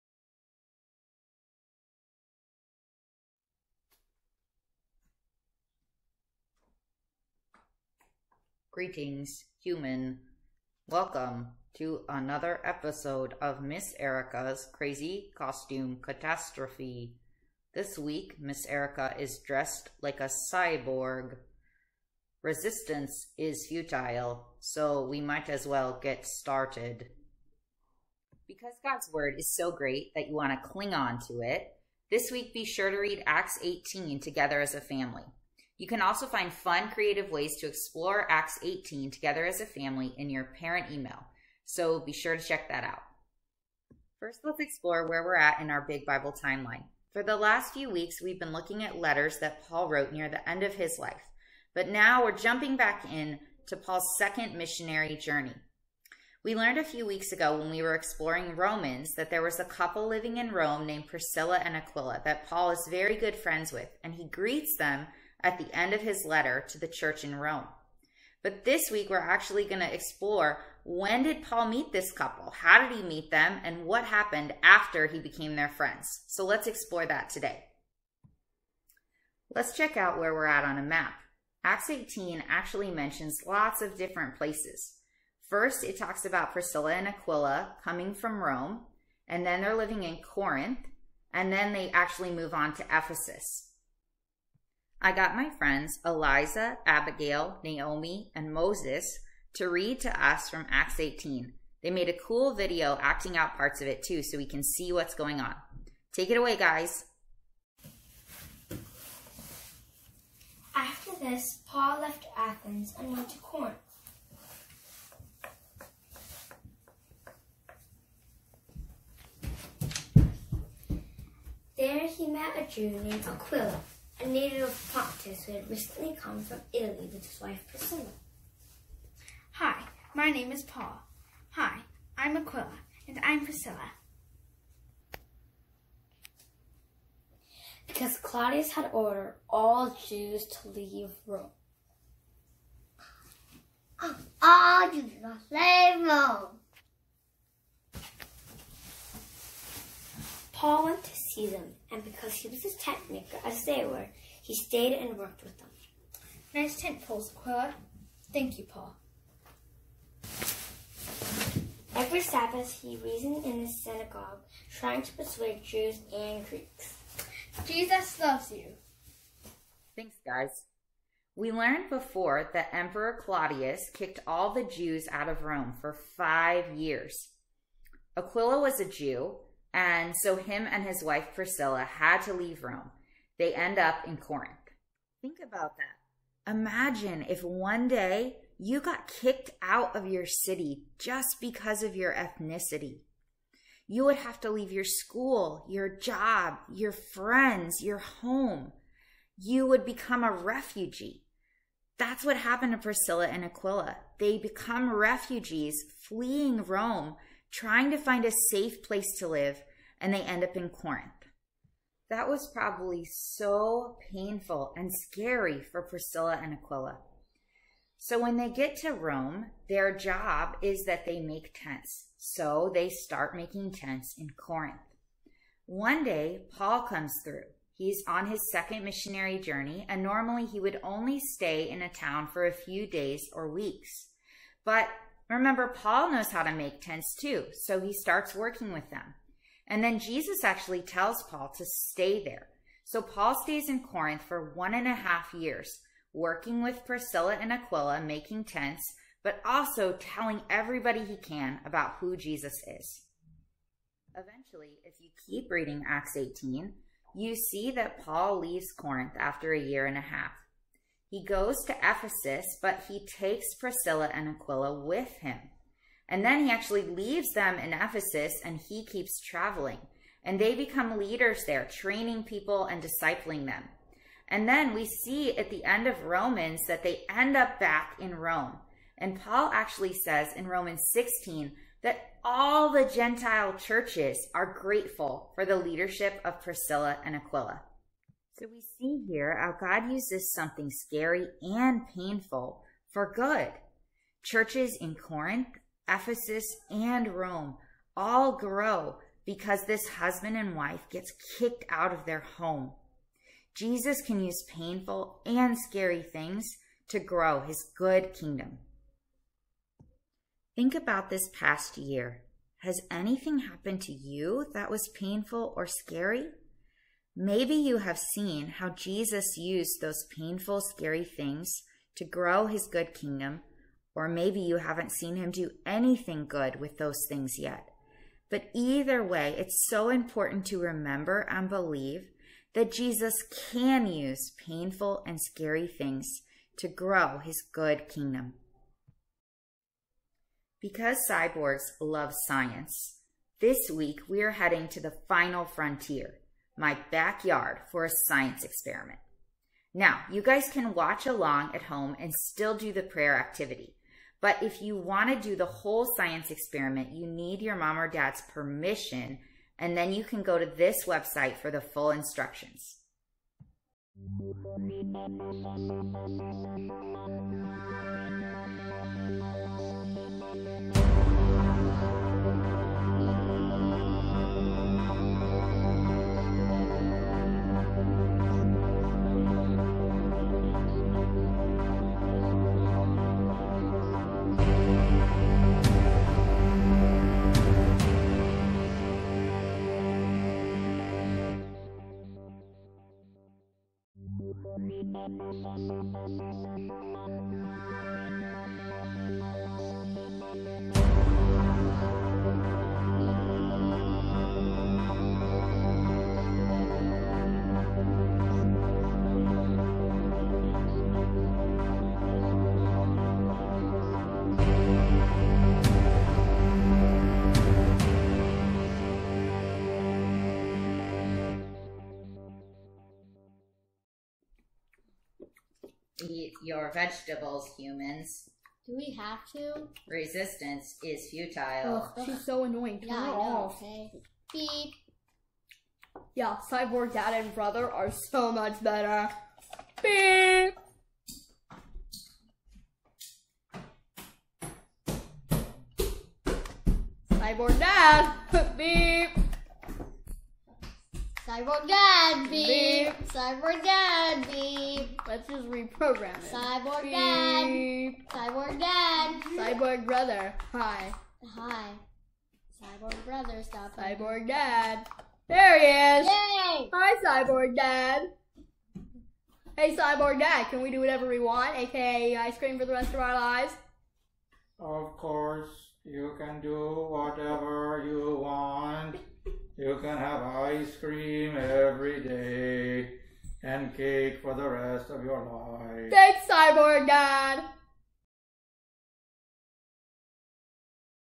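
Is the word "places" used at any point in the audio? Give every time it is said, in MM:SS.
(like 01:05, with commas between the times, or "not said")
01:24, 03:28.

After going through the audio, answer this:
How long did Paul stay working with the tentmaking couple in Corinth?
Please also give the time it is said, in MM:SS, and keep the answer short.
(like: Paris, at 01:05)
1.5 years, at 04:04.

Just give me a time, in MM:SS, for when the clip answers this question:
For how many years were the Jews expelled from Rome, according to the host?
02:55.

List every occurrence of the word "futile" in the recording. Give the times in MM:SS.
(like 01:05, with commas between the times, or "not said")
00:23, 07:11.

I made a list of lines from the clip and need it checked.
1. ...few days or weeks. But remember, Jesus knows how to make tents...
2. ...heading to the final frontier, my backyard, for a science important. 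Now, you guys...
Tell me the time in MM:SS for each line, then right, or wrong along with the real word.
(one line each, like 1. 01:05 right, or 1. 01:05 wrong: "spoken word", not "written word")
1. 03:52 wrong: "Paul", not "Jesus"
2. 05:44 wrong: "experiment", not "important".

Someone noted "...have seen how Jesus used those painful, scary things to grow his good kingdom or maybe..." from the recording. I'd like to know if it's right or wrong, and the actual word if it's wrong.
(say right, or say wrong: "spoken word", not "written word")
right.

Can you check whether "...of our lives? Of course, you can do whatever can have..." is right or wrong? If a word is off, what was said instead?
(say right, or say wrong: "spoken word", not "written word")
right.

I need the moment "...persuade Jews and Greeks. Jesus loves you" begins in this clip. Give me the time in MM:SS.
02:45.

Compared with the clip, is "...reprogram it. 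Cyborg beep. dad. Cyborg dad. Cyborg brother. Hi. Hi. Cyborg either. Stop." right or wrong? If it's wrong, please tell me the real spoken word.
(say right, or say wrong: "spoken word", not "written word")
wrong: "brother", not "either".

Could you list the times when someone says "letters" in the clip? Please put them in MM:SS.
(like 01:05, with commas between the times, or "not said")
00:48, 01:06.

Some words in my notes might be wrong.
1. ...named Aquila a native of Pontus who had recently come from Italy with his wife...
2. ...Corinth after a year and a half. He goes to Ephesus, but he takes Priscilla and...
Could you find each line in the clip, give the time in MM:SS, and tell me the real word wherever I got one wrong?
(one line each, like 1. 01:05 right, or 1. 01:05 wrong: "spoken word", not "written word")
1. 02:03 right
2. 04:18 right.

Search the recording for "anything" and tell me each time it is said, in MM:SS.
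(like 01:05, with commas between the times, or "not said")
05:12, 05:25.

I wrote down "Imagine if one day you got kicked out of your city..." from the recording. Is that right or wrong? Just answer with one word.
right.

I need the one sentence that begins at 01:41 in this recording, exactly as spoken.
They made a cool video acting out parts of it too so we can see what's going on.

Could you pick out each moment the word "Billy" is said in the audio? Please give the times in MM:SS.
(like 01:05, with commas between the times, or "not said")
not said.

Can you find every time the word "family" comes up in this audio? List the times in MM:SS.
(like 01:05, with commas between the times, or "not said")
00:34, 00:39.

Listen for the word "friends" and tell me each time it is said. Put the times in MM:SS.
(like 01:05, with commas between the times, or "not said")
01:03, 01:15, 01:35, 03:16.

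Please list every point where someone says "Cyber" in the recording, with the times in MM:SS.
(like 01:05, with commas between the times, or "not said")
07:33, 07:43.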